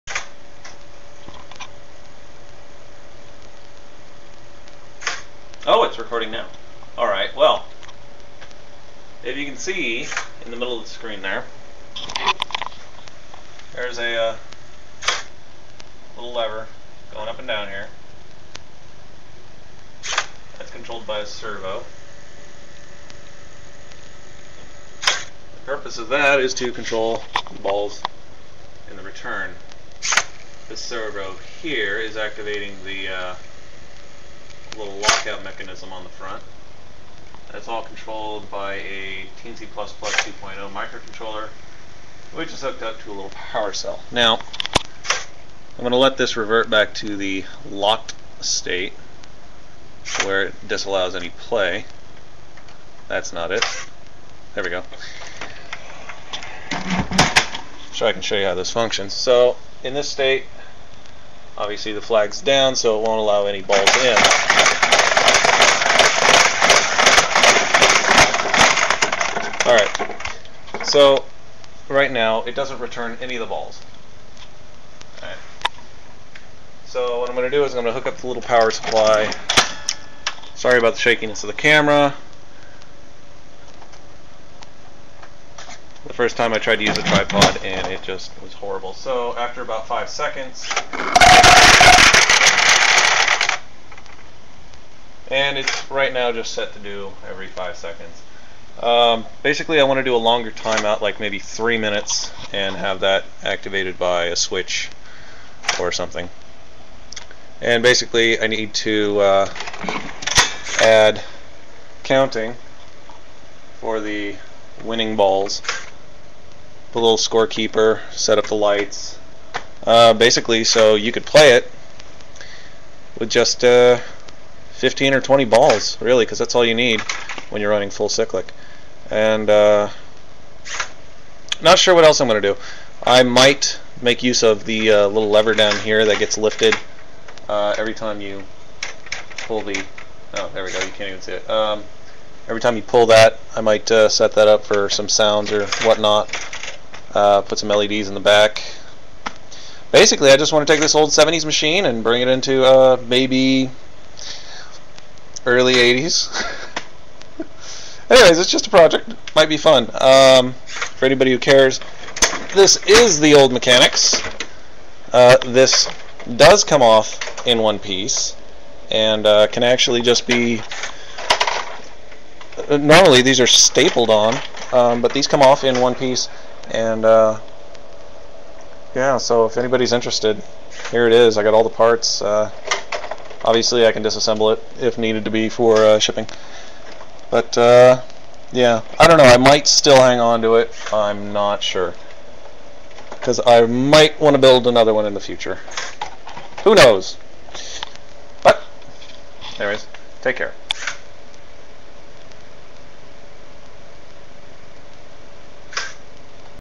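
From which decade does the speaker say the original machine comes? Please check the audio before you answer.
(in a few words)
The 70s.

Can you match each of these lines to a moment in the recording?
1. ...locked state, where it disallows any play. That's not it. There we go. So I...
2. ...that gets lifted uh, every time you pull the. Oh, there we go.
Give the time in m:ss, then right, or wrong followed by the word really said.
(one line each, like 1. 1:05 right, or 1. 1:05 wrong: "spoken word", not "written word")
1. 0:47 right
2. 2:16 right.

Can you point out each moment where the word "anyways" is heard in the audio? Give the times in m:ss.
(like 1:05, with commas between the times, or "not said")
2:38, 3:19.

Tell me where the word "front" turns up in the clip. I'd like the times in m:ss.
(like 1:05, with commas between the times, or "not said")
0:36.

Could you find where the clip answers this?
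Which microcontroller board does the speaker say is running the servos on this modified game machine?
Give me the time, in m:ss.
0:39.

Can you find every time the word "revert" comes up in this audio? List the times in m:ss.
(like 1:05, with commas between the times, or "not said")
0:46.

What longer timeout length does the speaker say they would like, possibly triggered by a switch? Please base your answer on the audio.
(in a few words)
3 minutes.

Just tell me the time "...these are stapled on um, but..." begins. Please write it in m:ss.
2:53.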